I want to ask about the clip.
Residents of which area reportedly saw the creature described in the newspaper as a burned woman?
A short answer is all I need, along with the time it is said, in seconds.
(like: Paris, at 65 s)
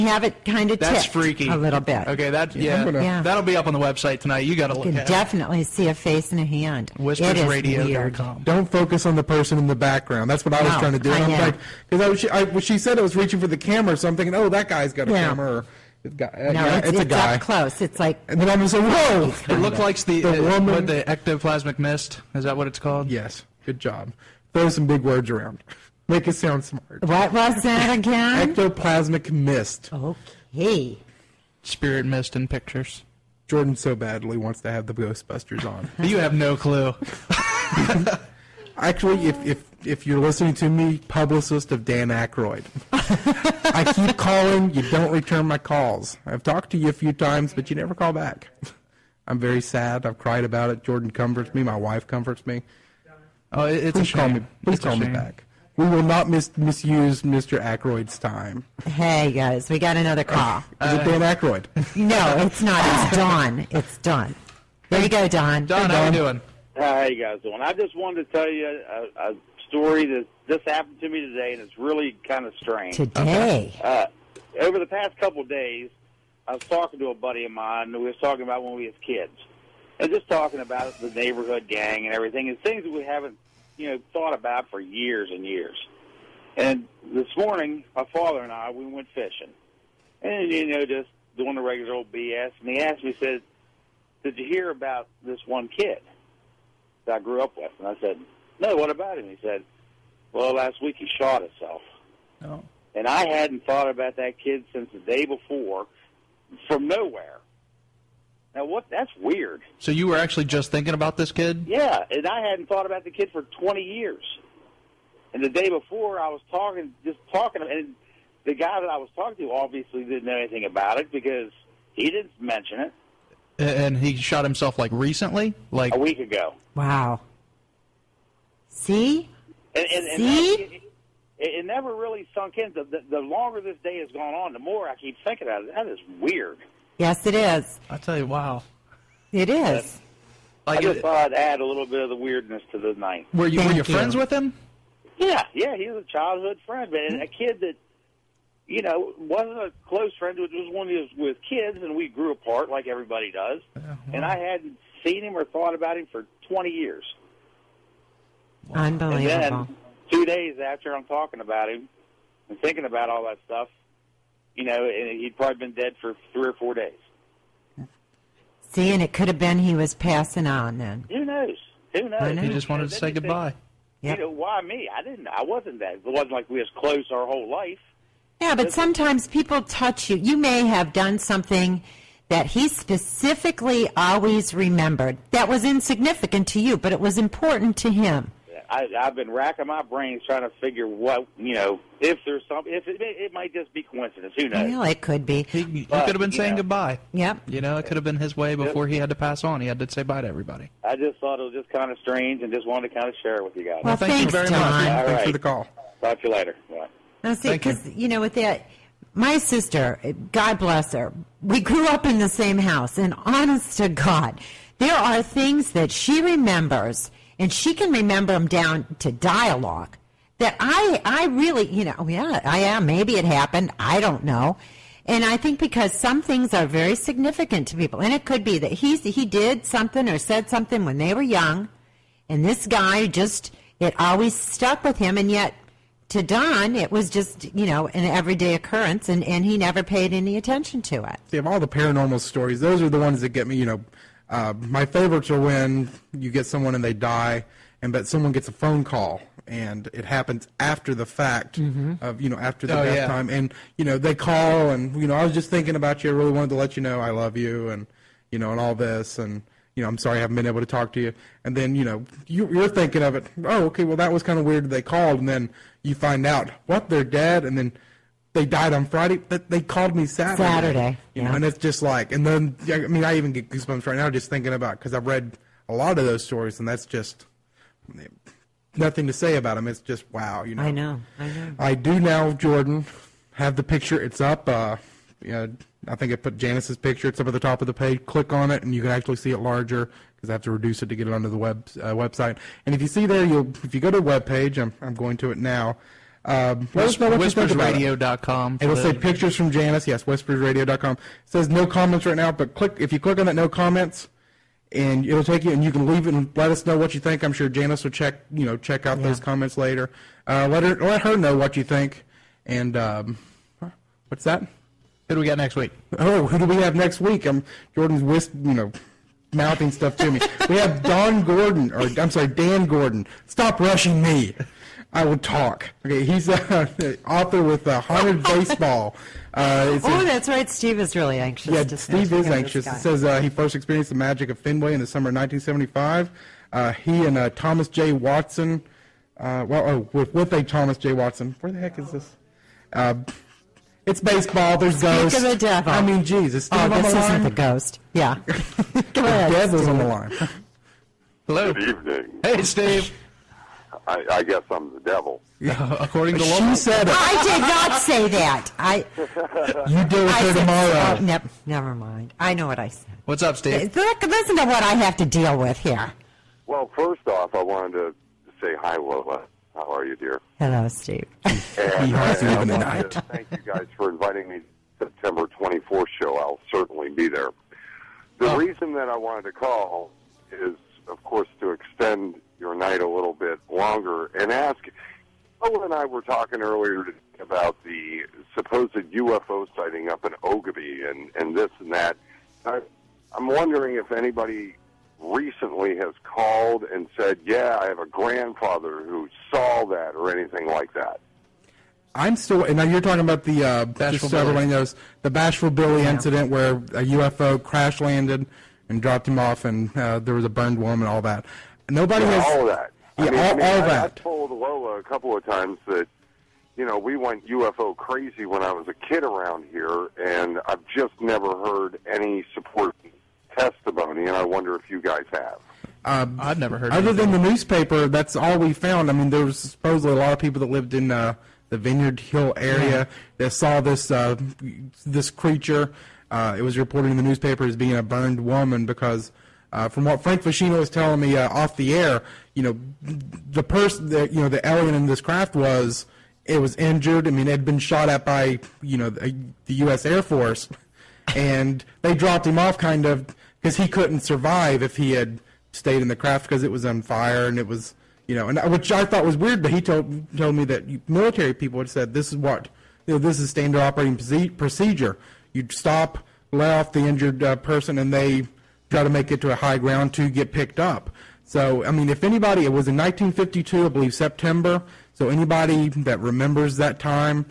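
Vineyard Hill, at 431 s.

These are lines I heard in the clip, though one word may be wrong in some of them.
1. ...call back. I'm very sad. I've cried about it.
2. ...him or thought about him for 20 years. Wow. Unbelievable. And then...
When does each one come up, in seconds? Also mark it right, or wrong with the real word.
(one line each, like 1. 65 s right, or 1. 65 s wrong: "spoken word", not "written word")
1. 47 s right
2. 155 s right.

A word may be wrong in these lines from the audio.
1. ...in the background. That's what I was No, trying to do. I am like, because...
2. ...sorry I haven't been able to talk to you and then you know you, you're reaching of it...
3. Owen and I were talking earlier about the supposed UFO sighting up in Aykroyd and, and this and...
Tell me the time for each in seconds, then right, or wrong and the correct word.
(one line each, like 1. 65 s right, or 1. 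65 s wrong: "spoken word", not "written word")
1. 9 s right
2. 259 s wrong: "thinking", not "reaching"
3. 385 s wrong: "Oglebay", not "Aykroyd".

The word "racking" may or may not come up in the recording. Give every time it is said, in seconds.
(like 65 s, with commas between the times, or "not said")
189 s.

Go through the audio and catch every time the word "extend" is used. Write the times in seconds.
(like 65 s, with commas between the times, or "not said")
381 s.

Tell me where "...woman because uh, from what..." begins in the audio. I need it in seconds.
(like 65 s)
438 s.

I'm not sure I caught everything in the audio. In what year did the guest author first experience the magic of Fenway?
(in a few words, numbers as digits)
1975.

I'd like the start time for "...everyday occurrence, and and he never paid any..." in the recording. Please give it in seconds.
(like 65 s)
238 s.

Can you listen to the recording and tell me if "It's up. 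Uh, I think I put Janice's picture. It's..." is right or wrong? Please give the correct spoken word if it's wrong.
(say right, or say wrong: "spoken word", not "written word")
right.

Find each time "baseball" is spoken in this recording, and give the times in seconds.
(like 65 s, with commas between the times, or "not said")
328 s, 344 s.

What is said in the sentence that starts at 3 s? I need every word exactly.
that'll be up on the website tonight.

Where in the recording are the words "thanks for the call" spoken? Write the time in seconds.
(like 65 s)
205 s.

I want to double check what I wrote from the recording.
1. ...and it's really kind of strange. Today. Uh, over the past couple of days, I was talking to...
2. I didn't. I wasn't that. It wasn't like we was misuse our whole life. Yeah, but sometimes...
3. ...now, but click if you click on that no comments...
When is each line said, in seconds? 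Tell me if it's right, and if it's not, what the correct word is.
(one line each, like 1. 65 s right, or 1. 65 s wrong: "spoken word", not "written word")
1. 71 s right
2. 174 s wrong: "close", not "misuse"
3. 302 s right.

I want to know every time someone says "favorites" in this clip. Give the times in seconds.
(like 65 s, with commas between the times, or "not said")
244 s.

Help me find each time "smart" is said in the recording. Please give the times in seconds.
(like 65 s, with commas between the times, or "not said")
26 s.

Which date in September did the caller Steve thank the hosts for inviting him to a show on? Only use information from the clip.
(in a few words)
September 24th.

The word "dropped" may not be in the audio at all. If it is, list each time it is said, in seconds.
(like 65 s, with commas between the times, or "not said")
408 s, 451 s.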